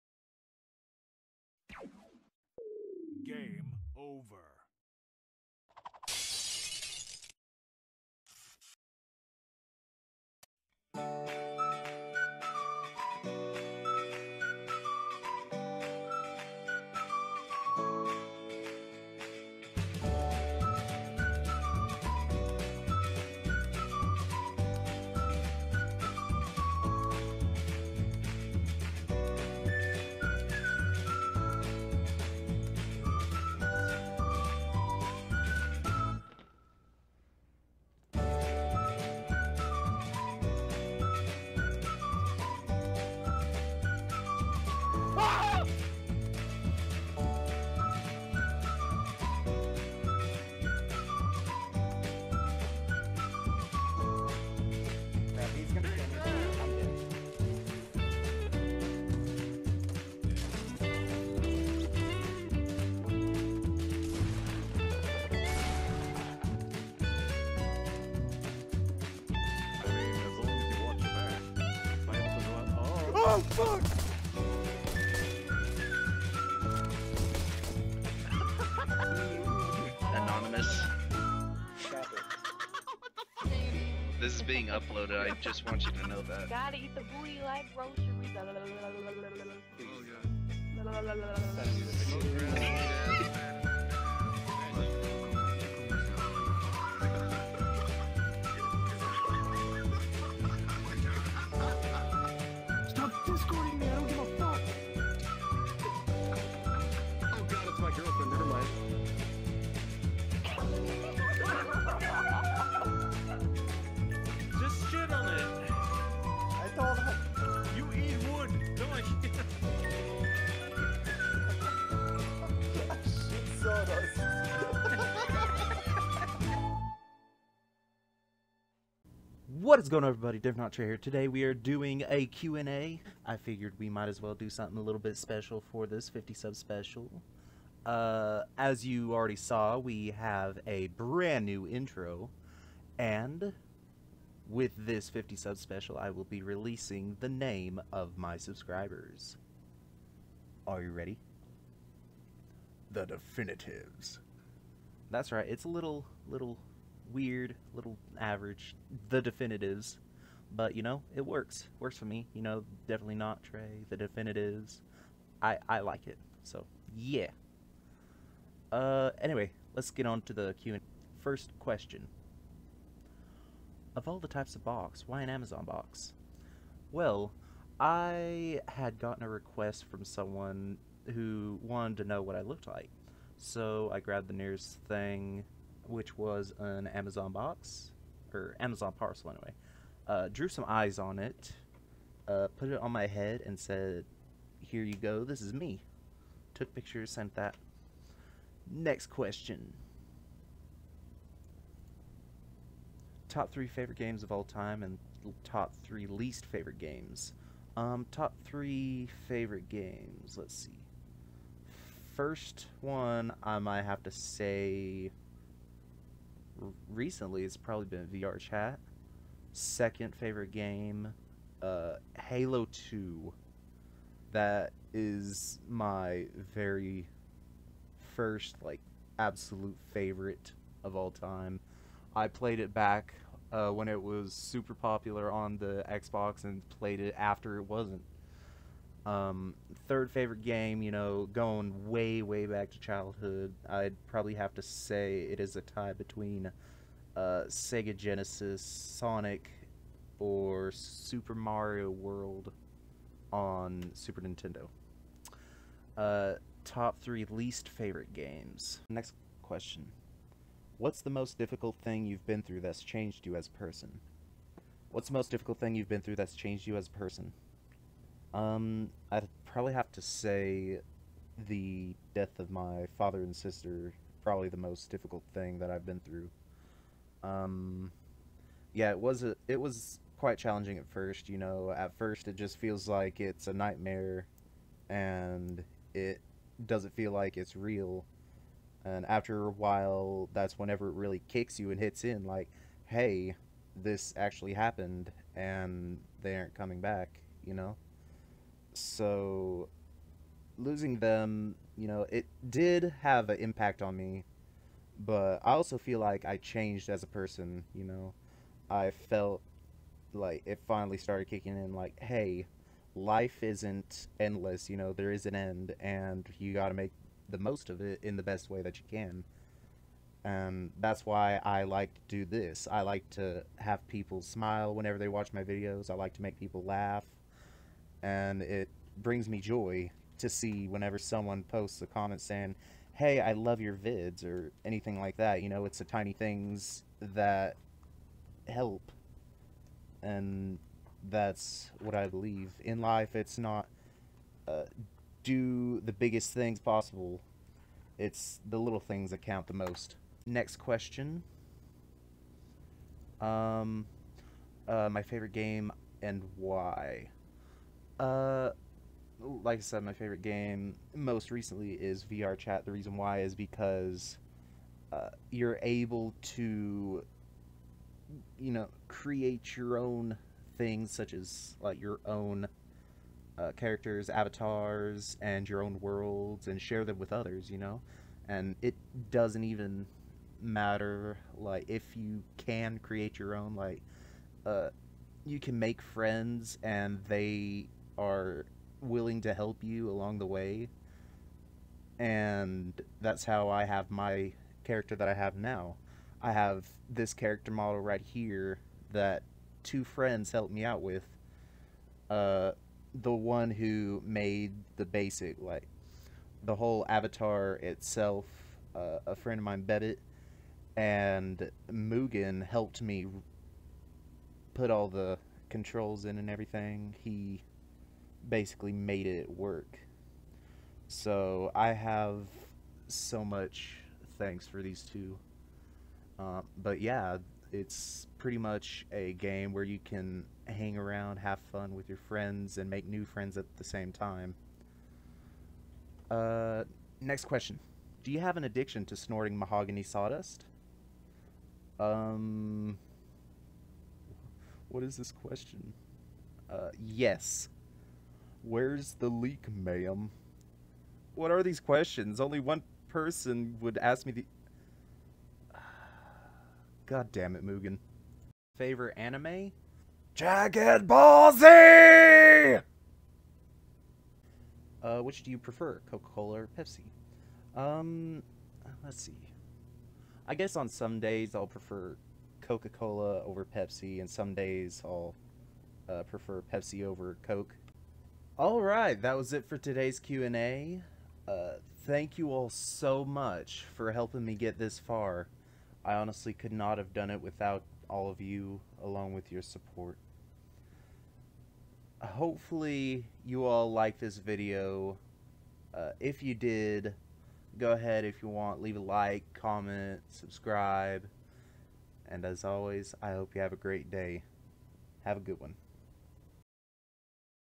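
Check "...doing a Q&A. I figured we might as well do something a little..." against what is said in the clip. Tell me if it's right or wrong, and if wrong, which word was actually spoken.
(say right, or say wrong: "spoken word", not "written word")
right.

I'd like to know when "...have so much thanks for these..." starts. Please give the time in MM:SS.
07:01.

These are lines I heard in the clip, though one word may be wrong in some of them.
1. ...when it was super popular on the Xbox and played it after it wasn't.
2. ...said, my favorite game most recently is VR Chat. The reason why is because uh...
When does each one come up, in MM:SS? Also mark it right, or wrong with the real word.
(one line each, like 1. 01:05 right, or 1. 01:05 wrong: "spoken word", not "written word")
1. 03:53 right
2. 05:59 right.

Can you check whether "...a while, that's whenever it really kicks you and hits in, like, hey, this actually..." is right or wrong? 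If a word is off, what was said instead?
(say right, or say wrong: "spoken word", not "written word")
right.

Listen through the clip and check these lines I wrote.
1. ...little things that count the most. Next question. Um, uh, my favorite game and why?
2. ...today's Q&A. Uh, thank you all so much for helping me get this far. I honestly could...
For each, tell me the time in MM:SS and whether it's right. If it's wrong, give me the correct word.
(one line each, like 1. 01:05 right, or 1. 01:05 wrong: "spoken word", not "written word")
1. 05:48 right
2. 07:59 right.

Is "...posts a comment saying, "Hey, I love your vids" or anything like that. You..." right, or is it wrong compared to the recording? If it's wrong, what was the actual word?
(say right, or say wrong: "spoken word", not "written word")
right.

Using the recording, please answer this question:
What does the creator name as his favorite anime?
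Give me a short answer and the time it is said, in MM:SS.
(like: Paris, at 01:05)
Dragon Ball Z, at 07:40.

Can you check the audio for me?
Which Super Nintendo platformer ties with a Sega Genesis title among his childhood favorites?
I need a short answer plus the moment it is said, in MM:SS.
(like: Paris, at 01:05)
Super Mario World, at 04:10.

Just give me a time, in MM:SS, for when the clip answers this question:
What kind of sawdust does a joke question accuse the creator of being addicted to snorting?
07:19.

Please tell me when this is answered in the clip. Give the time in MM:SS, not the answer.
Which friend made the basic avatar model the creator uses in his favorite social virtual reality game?
06:49.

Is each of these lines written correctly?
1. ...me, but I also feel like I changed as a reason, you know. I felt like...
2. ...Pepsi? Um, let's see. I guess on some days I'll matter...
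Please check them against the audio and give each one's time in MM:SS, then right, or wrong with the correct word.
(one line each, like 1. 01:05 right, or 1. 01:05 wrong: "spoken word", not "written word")
1. 05:03 wrong: "person", not "reason"
2. 07:46 wrong: "prefer", not "matter".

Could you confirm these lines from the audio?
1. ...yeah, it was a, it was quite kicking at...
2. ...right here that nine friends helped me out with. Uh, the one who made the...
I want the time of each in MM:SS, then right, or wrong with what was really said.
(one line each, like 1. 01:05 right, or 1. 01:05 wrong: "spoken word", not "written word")
1. 04:38 wrong: "challenging", not "kicking"
2. 06:37 wrong: "two", not "nine".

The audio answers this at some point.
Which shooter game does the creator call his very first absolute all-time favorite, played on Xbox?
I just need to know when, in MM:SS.
03:42.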